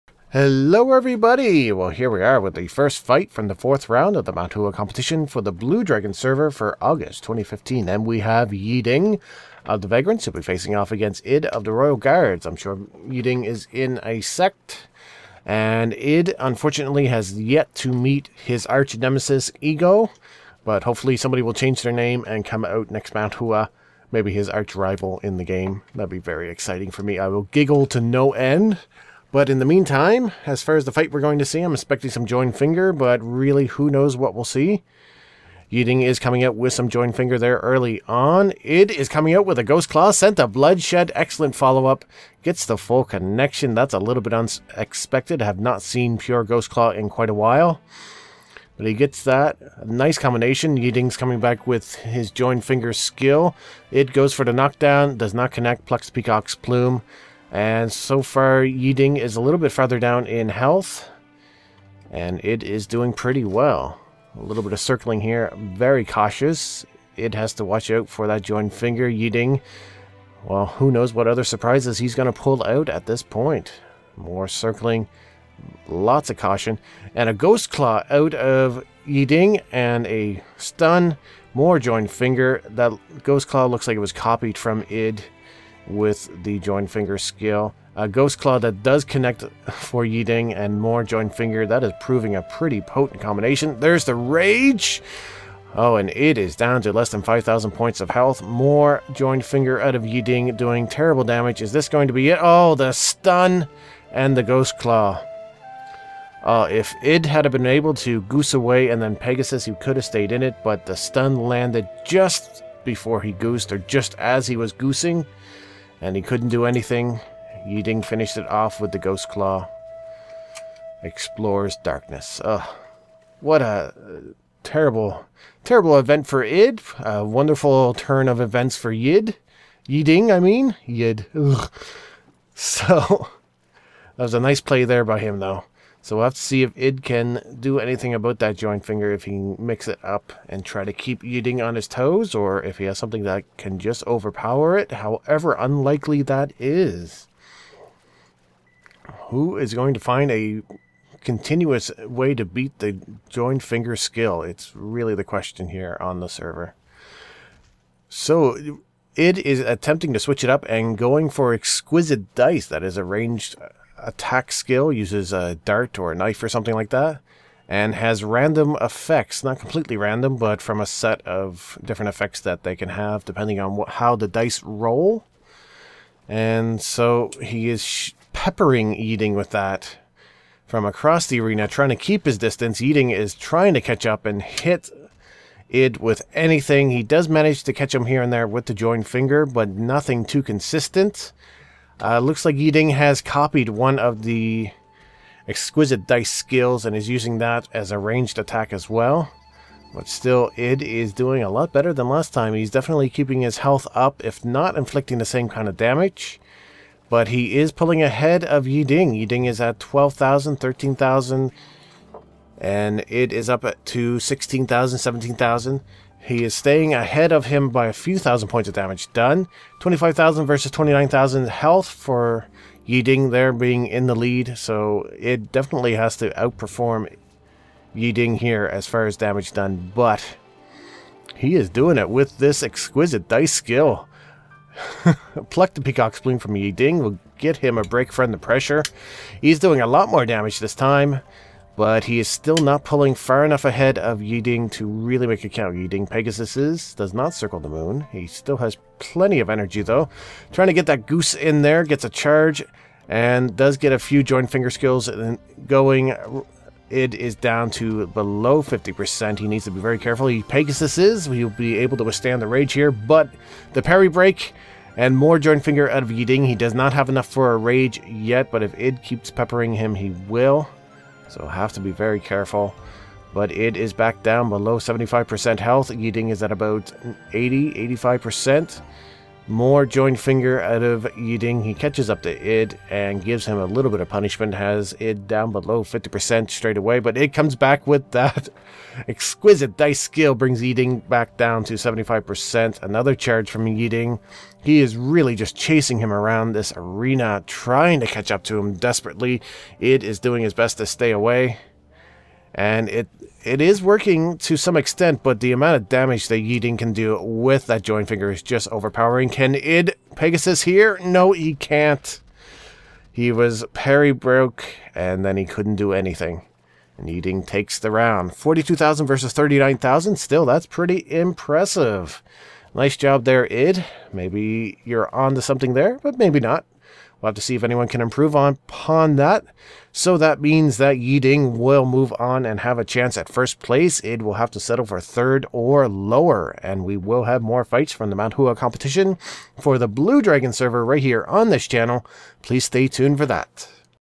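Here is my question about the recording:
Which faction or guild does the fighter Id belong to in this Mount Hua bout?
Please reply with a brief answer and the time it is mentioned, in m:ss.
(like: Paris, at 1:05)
Royal Guards, at 0:11.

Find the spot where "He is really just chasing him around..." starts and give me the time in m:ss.
4:54.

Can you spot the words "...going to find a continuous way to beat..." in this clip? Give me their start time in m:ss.
2:29.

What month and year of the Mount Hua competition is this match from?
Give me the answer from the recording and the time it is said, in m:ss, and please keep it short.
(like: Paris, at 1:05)
August 2015, at 0:06.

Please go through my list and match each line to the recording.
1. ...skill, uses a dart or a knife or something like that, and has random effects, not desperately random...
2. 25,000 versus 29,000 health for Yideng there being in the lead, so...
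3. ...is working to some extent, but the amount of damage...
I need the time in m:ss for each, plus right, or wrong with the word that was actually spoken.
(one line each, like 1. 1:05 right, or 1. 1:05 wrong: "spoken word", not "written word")
1. 2:44 wrong: "completely", not "desperately"
2. 3:39 right
3. 5:03 right.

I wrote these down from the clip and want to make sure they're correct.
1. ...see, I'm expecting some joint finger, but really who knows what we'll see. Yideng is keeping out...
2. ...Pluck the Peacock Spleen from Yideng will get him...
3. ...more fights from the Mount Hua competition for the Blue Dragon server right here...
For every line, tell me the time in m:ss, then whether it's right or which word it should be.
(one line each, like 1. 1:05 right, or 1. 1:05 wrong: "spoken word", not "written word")
1. 0:31 wrong: "coming", not "keeping"
2. 3:55 right
3. 5:37 right.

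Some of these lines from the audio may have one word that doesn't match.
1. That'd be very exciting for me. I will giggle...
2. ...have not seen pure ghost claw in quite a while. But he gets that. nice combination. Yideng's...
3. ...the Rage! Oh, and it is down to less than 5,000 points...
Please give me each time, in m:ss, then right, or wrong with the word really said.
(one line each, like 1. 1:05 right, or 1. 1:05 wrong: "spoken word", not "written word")
1. 0:25 right
2. 0:45 right
3. 1:34 right.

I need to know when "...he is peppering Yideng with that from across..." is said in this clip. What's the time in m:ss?
2:57.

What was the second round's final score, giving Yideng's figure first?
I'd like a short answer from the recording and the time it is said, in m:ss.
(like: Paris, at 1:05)
42,000 versus 39,000, at 5:18.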